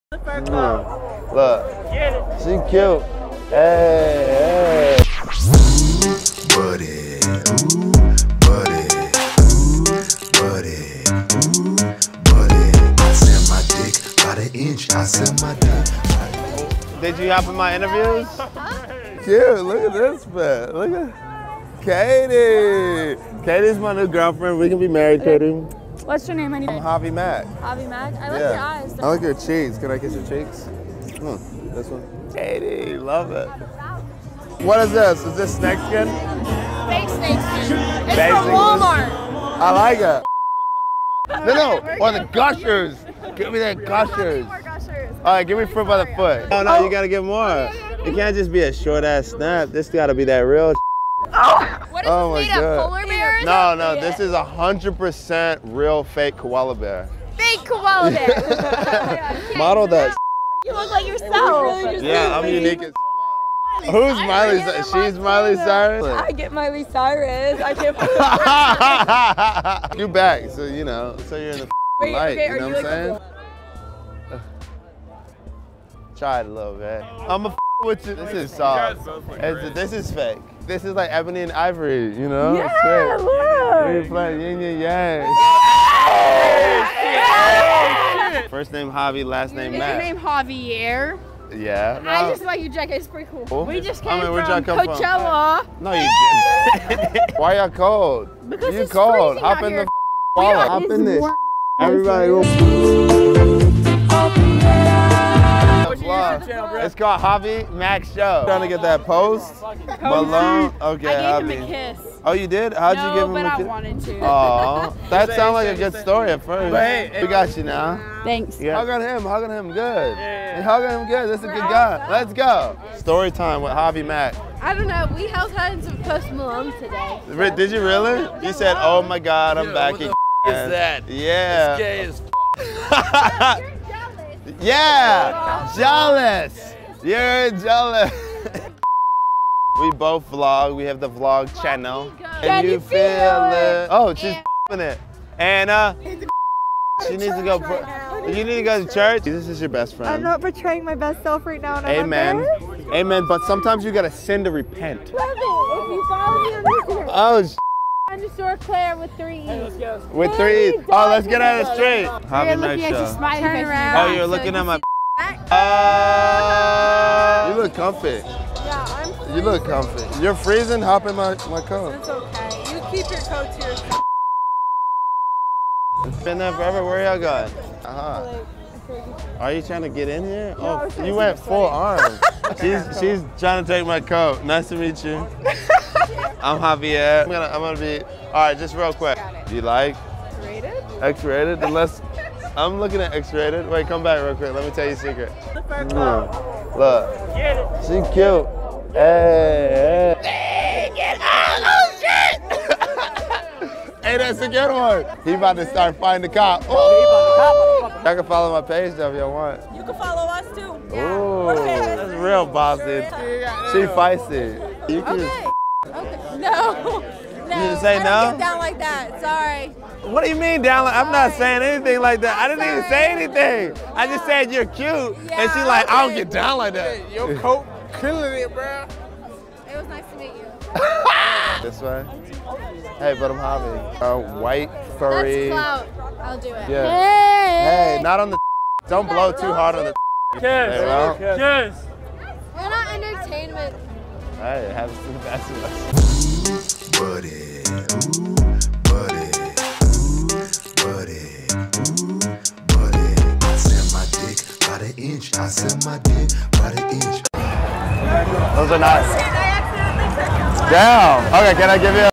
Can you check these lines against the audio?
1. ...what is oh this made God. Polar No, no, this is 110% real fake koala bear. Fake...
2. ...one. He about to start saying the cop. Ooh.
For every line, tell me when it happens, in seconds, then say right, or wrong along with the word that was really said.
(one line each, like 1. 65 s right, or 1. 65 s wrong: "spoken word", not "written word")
1. 51 s wrong: "100", not "110"
2. 204 s wrong: "fighting", not "saying".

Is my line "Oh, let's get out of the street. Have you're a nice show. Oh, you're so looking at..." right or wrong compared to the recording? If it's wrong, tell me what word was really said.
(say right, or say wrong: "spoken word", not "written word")
right.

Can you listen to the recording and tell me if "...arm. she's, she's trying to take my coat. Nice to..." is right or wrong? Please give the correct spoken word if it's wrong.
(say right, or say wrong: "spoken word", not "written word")
right.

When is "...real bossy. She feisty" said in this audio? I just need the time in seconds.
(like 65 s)
212 s.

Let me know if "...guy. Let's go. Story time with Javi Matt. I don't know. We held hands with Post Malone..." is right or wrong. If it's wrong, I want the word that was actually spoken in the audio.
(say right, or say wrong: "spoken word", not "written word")
wrong: "Mac", not "Matt".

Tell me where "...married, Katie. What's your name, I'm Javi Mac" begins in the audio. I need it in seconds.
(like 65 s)
24 s.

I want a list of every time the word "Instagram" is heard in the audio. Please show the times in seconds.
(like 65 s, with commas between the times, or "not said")
156 s.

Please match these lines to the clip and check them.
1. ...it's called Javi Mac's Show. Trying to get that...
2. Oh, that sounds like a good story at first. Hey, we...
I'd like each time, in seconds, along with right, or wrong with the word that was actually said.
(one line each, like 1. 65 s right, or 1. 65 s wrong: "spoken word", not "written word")
1. 106 s right
2. 114 s right.